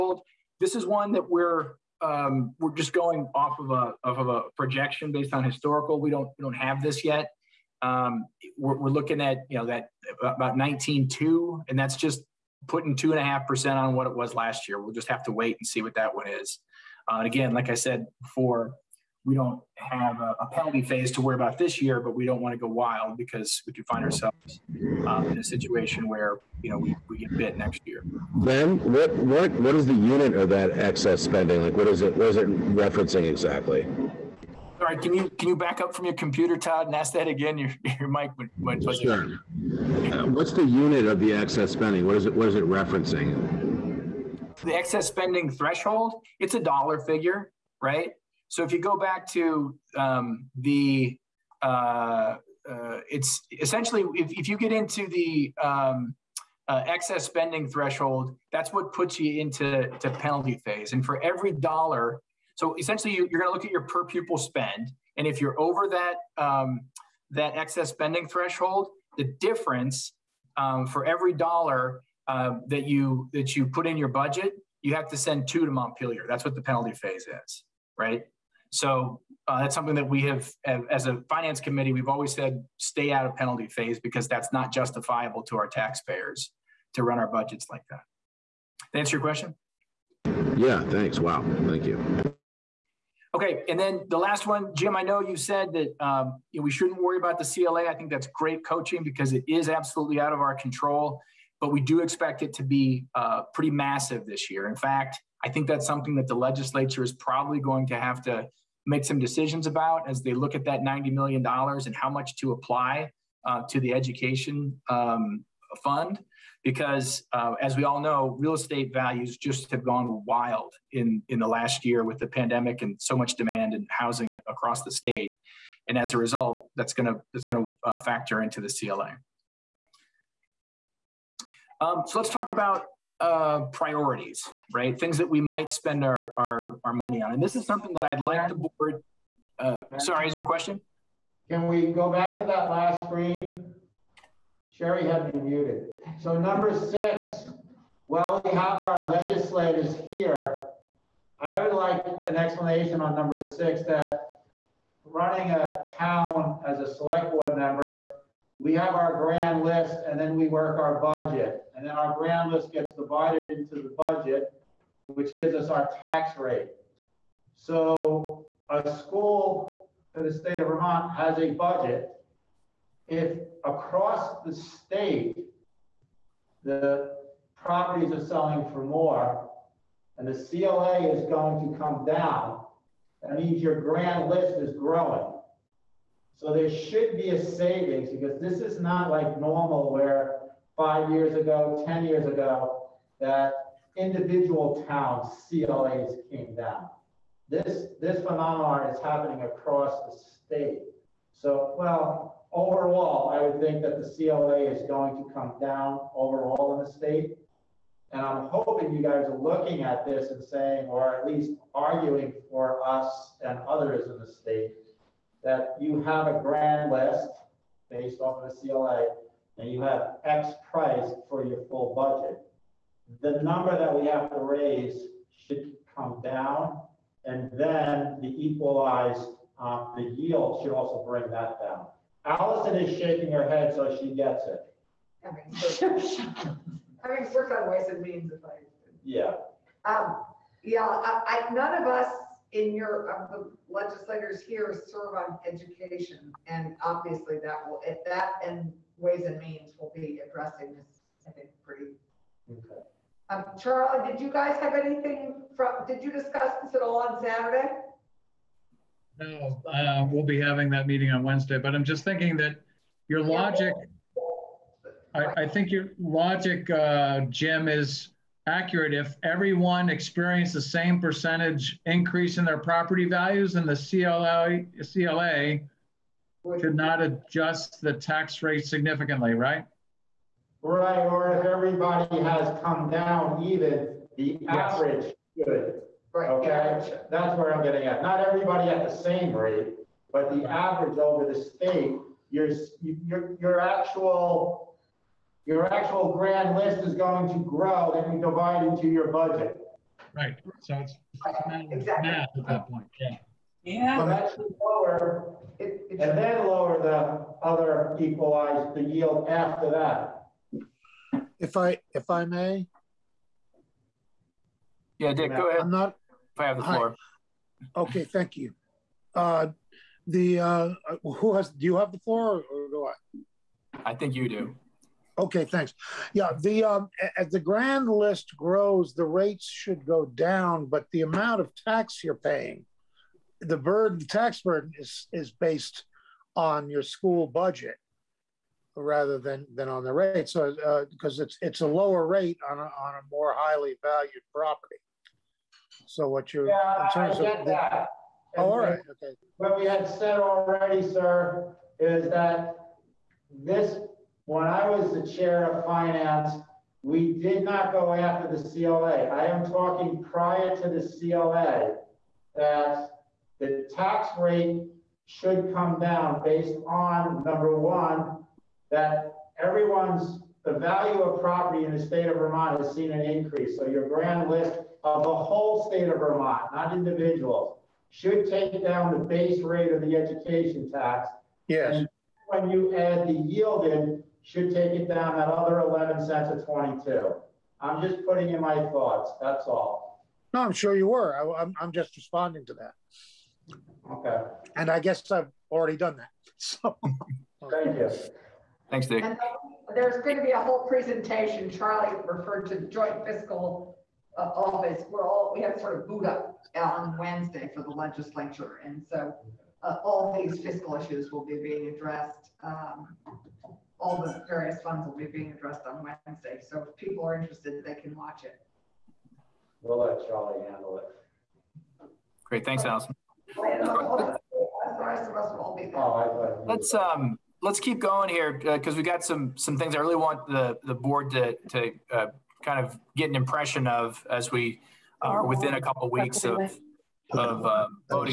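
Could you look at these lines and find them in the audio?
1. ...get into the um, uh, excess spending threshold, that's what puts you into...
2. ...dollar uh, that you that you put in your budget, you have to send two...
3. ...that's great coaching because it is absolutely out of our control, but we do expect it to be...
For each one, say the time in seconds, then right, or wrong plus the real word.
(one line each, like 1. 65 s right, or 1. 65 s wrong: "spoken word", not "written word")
1. 54 s right
2. 71 s right
3. 98 s right.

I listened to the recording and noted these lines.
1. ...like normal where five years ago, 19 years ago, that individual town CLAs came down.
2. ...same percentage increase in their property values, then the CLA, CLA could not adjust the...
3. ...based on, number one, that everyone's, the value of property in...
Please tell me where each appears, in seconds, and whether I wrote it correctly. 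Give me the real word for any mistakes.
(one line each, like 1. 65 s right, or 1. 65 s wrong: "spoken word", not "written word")
1. 189 s wrong: "10", not "19"
2. 270 s right
3. 366 s right.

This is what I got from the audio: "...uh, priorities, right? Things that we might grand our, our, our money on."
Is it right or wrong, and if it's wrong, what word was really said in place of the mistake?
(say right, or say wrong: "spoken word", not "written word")
wrong: "spend", not "grand".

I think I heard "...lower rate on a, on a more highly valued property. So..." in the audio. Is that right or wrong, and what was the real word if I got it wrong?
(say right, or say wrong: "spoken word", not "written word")
right.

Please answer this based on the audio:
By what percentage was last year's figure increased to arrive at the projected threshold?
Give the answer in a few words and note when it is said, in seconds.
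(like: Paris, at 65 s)
2.5 percent, at 12 s.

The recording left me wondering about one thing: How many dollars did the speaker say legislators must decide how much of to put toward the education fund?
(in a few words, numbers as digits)
$90 million.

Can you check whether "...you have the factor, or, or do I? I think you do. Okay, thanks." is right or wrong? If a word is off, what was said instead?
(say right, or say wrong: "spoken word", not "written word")
wrong: "floor", not "factor".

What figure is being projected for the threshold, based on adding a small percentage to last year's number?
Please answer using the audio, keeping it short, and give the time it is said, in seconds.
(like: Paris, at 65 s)
19.2, at 10 s.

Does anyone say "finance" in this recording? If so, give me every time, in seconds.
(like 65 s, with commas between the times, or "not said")
81 s, 355 s.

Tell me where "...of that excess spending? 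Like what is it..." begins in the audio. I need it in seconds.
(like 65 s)
30 s.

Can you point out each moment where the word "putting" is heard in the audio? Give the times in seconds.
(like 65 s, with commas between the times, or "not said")
12 s, 388 s.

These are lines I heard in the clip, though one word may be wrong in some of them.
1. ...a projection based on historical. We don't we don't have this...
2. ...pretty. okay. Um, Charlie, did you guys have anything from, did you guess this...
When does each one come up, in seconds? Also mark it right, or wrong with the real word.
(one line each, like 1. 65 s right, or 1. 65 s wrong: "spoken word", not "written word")
1. 4 s right
2. 251 s wrong: "discuss", not "guess".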